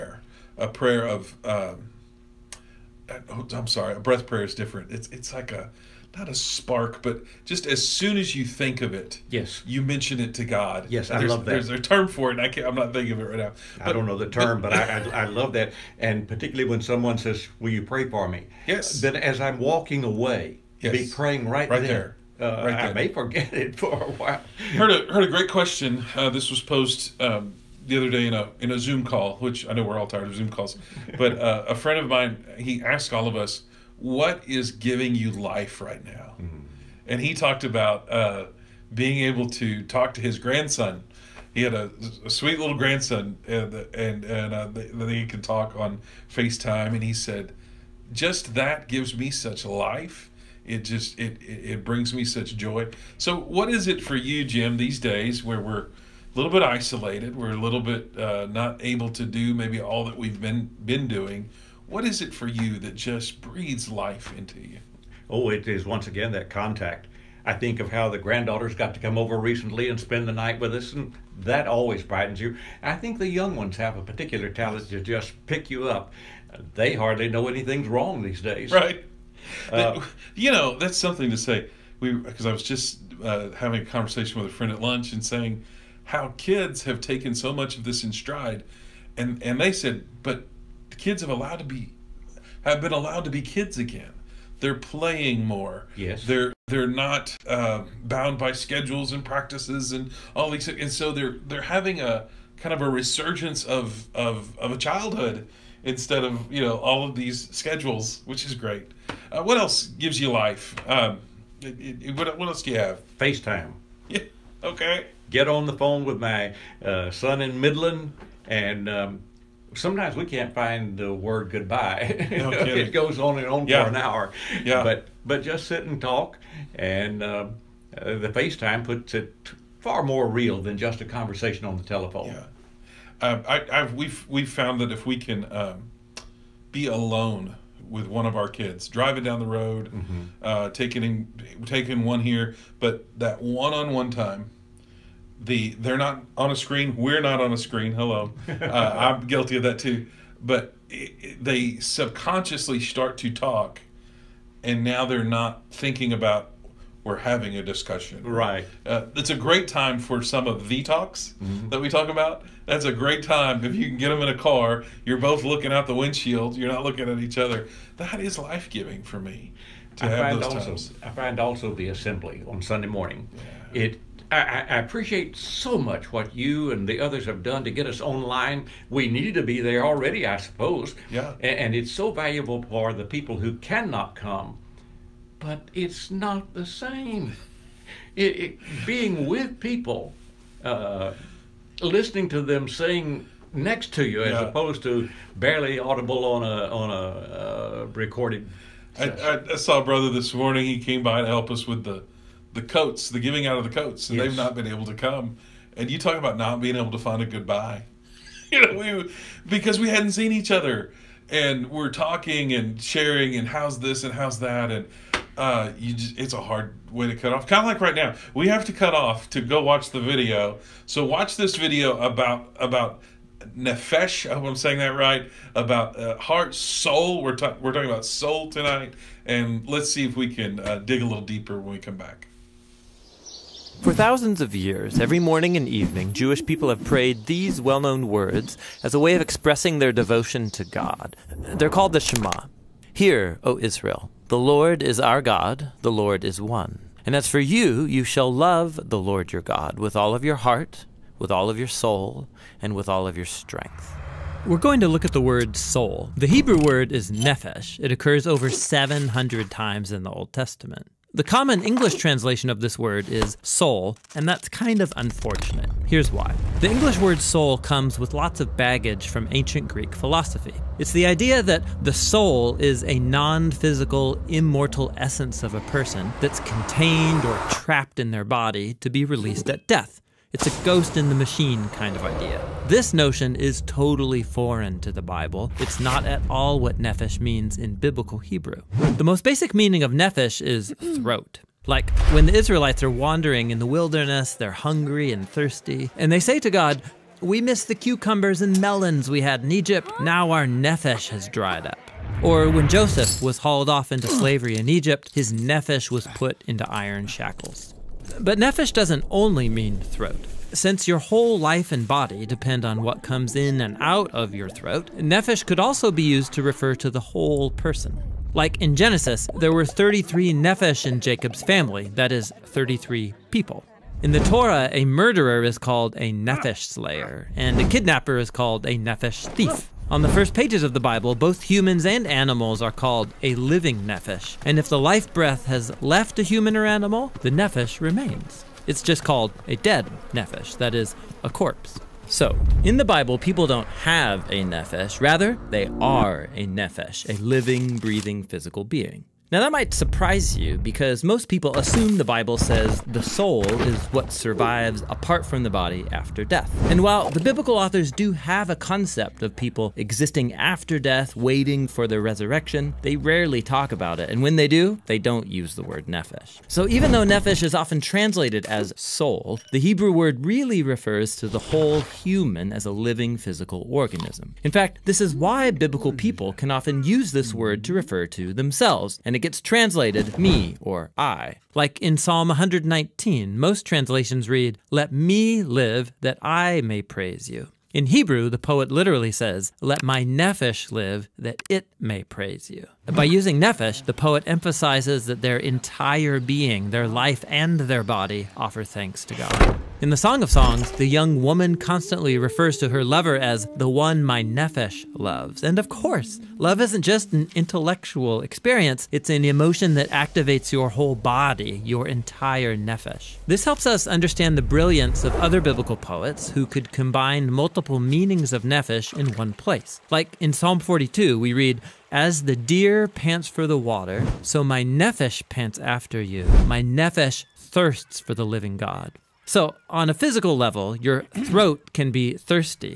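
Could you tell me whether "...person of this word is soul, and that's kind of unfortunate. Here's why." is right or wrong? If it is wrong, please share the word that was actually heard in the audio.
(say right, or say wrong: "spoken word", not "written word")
wrong: "translation", not "person".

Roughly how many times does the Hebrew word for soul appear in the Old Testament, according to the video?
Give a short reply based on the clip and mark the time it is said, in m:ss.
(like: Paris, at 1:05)
Over 700, at 4:18.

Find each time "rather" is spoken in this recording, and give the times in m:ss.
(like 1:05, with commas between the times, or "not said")
5:44.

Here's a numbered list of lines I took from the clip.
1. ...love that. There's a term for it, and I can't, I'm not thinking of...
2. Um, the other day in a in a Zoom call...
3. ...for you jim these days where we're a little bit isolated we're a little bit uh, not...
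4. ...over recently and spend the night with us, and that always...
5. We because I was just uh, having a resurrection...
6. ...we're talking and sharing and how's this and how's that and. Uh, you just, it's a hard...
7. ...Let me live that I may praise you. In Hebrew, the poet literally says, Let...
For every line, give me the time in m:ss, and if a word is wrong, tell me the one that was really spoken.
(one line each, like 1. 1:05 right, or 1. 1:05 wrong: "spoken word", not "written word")
1. 0:11 right
2. 0:27 right
3. 0:54 right
4. 1:09 right
5. 1:22 wrong: "conversation", not "resurrection"
6. 3:31 right
7. 6:24 right.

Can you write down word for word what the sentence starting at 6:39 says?
In the Song of Songs, the young woman constantly refers to her lover as the one my nephesh loves.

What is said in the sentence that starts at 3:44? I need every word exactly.
I hope I'm saying that right.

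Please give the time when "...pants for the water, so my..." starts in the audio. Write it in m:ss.
7:02.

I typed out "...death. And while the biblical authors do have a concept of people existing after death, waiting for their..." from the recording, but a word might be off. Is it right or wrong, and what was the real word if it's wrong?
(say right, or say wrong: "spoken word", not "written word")
right.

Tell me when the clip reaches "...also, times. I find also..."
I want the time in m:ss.
2:50.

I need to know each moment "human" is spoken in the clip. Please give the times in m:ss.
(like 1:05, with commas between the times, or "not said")
5:31, 5:36, 6:11.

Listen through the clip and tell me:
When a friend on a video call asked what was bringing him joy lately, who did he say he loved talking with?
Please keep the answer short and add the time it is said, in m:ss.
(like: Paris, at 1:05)
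His grandson, at 0:40.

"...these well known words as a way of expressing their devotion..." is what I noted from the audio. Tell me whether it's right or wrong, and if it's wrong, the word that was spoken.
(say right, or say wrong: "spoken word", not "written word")
right.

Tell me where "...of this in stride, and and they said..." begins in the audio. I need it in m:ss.
1:27.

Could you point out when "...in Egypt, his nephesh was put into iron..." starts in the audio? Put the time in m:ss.
5:04.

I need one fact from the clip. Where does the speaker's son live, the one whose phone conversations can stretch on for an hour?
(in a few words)
Midland.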